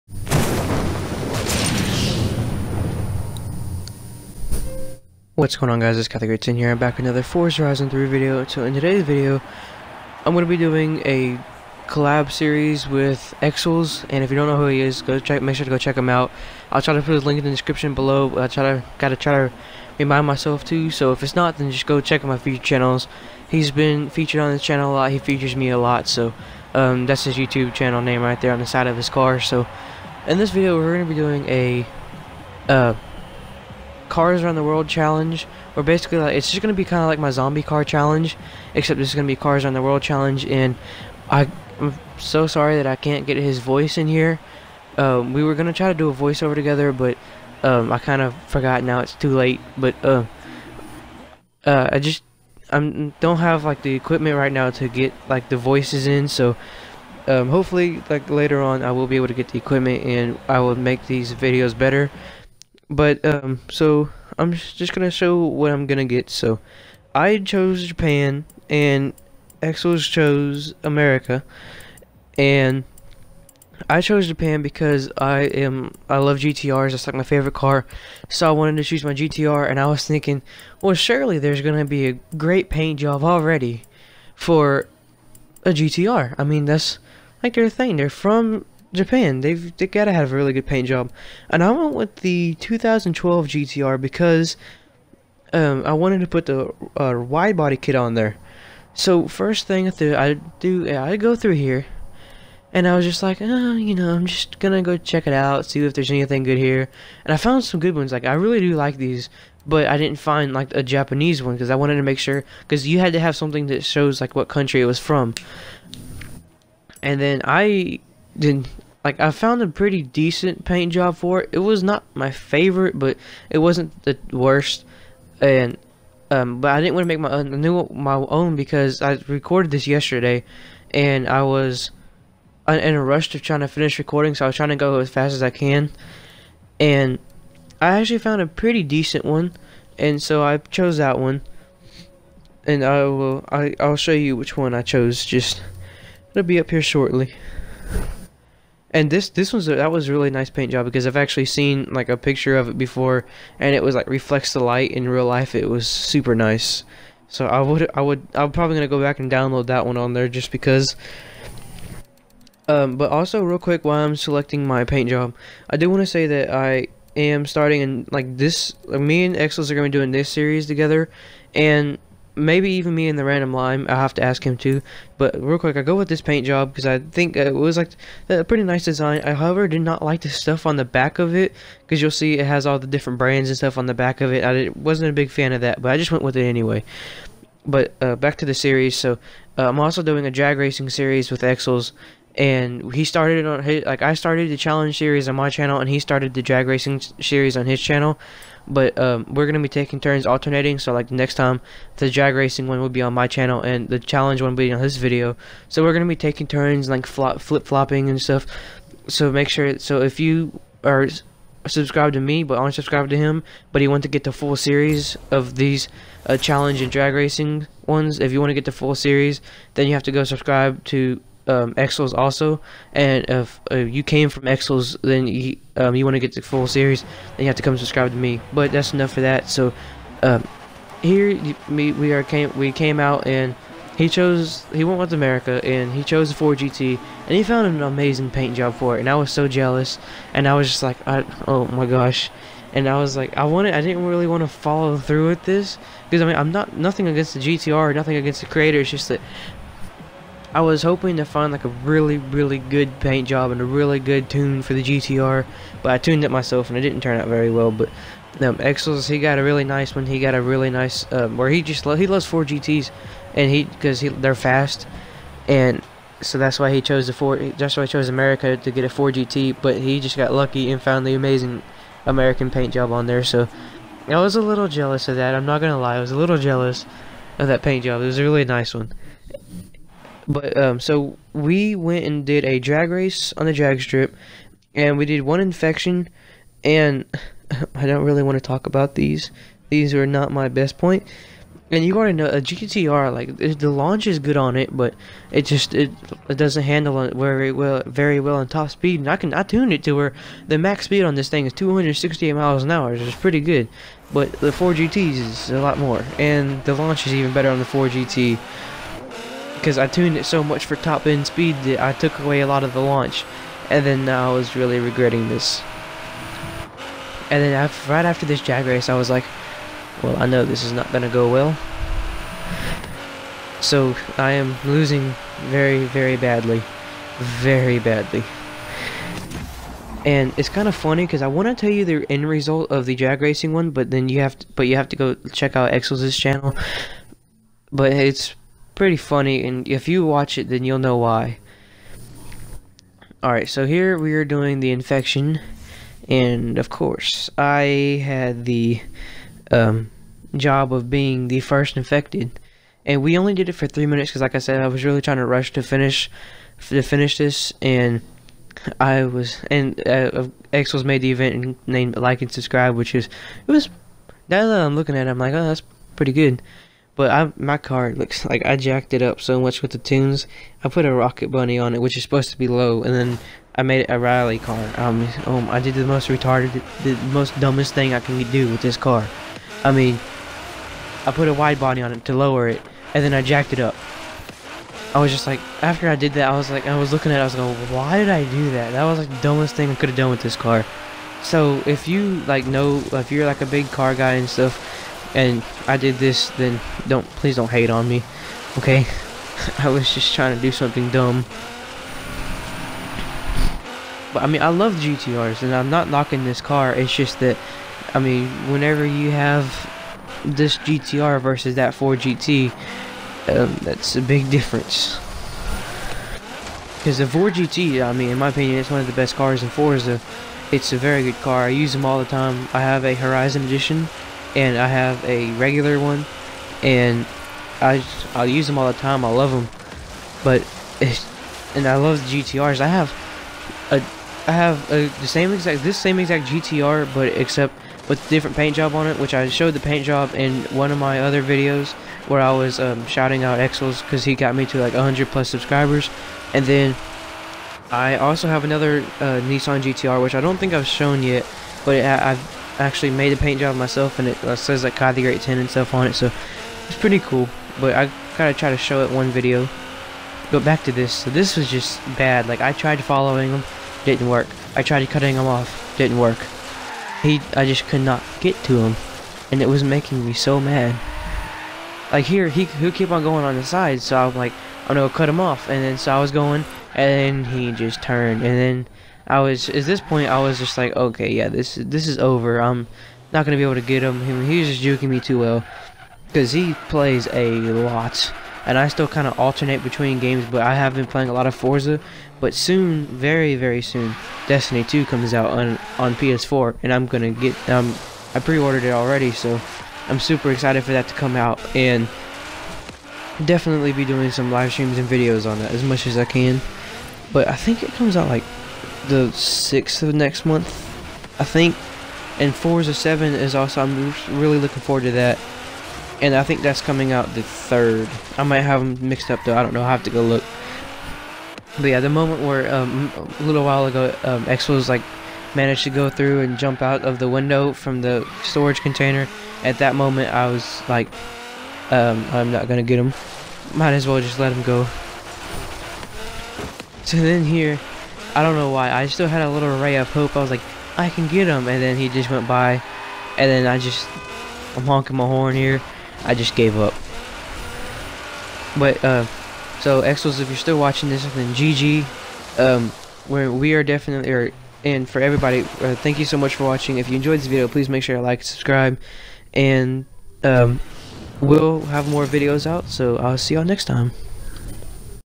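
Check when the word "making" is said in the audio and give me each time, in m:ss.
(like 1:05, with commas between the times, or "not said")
7:49.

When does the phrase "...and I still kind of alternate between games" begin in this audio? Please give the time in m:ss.
8:08.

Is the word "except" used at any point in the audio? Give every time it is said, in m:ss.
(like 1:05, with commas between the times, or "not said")
0:38, 7:17.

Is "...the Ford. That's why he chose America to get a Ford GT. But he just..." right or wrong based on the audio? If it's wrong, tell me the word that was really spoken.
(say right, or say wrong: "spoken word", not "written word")
right.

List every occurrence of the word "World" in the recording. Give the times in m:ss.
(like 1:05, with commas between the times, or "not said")
0:34, 0:39.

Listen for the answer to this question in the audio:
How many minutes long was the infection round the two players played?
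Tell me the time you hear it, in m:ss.
5:53.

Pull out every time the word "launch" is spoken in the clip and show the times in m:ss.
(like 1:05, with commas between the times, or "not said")
4:53, 5:06, 5:12.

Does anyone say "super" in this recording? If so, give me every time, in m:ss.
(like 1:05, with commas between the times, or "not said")
2:35, 8:19.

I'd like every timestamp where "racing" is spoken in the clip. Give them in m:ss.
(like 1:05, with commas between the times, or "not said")
3:10, 3:16, 3:22, 3:37, 5:33.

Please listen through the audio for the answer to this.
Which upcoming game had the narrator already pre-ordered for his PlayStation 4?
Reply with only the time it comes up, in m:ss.
8:14.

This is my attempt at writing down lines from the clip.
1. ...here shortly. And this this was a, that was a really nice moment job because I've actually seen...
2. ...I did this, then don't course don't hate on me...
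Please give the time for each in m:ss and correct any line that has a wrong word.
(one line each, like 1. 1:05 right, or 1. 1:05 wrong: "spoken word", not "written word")
1. 2:26 wrong: "paint", not "moment"
2. 6:35 wrong: "please", not "course".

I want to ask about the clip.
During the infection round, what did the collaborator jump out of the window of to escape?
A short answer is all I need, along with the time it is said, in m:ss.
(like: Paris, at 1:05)
storage container, at 8:48.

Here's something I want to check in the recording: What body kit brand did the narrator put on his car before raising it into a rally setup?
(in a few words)
Rocket Bunny.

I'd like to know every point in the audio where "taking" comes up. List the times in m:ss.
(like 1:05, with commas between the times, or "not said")
3:19, 3:26.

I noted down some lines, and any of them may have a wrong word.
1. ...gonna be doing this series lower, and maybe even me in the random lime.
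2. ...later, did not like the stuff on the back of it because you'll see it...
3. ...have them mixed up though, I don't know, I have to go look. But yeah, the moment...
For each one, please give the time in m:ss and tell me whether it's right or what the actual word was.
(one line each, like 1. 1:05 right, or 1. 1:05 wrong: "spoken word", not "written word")
1. 2:49 wrong: "together", not "lower"
2. 2:59 wrong: "however", not "later"
3. 8:38 right.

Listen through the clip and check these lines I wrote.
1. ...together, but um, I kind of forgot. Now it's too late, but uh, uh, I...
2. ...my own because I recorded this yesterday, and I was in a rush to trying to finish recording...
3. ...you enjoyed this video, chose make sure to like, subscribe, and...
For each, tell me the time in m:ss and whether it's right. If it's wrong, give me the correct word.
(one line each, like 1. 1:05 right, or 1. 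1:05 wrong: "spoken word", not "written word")
1. 0:46 right
2. 2:08 right
3. 9:16 wrong: "please", not "chose".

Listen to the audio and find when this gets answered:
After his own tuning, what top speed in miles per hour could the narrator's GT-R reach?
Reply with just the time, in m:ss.
5:01.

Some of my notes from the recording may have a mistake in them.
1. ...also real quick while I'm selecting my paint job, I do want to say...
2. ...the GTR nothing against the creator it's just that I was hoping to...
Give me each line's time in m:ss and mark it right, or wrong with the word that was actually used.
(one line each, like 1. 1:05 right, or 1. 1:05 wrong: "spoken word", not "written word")
1. 2:43 right
2. 4:07 right.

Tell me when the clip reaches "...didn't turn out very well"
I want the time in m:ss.
4:16.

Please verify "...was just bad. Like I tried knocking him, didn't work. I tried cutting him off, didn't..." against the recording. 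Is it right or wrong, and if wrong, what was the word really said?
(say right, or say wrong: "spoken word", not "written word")
wrong: "following", not "knocking".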